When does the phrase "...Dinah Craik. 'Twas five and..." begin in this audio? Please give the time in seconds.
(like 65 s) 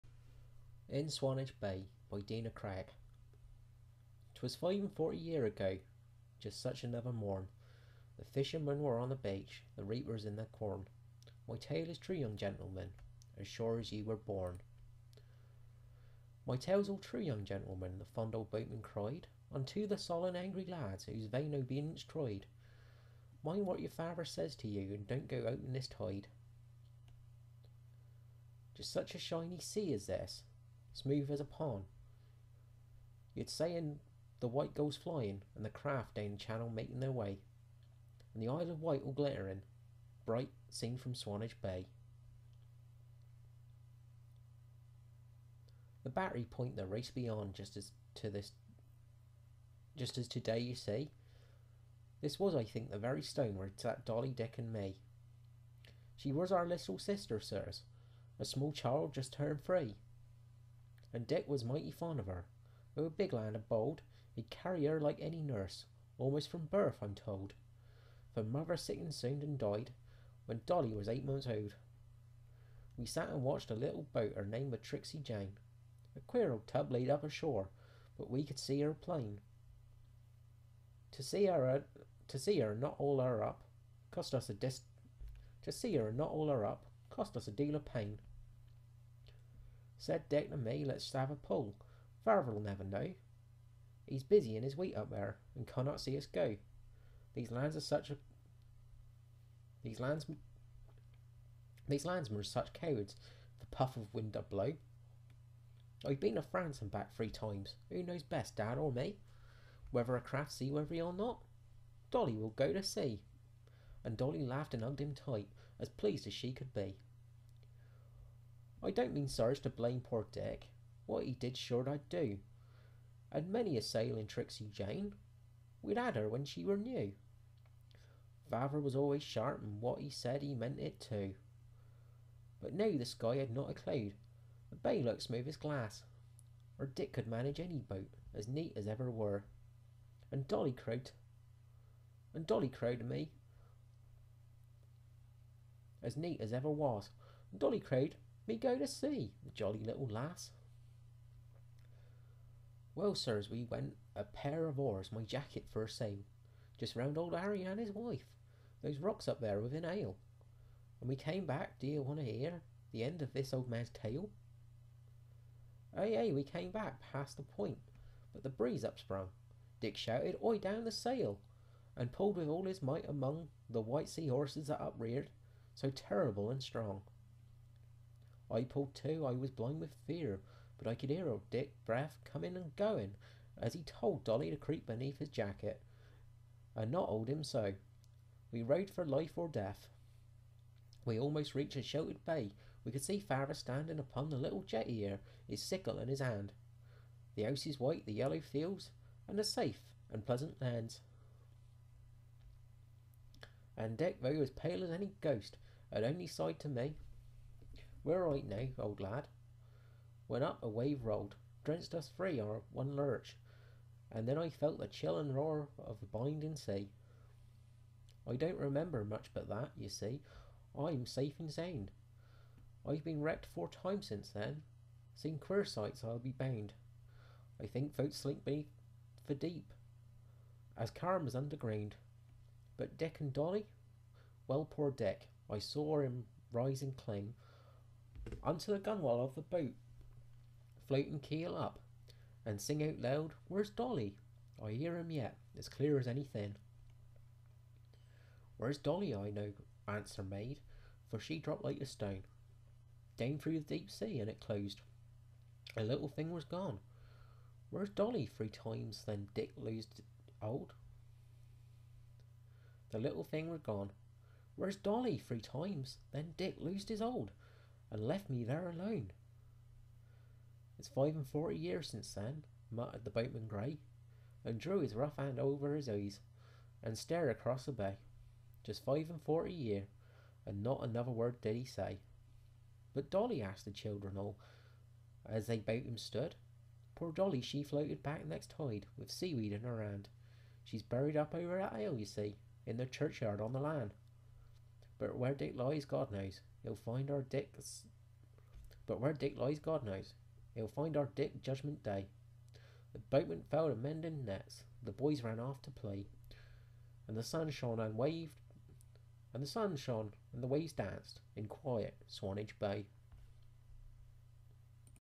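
2 s.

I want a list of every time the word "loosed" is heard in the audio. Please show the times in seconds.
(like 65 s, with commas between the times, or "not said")
259 s, 266 s.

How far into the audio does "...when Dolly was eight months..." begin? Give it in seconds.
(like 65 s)
70 s.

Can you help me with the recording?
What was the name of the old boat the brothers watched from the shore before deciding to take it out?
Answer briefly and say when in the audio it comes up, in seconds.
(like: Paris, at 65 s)
Tricksy Jane, at 74 s.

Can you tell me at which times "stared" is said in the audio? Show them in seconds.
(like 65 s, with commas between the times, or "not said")
276 s.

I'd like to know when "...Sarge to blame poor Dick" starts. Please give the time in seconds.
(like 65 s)
119 s.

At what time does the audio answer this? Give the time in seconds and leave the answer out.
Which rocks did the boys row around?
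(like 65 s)
157 s.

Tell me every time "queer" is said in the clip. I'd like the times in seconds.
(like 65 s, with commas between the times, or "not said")
76 s, 225 s.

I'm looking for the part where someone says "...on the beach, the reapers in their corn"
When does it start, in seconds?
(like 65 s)
8 s.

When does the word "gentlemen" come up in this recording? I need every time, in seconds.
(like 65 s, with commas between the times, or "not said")
12 s, 17 s.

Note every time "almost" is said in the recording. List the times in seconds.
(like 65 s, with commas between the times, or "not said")
66 s, 191 s.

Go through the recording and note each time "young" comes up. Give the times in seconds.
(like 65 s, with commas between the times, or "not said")
12 s, 17 s.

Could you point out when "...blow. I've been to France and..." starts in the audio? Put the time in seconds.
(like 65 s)
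104 s.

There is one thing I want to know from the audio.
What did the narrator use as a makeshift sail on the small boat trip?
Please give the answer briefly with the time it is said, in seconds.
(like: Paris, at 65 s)
his jacket, at 155 s.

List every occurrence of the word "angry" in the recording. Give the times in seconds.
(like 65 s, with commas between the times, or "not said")
20 s.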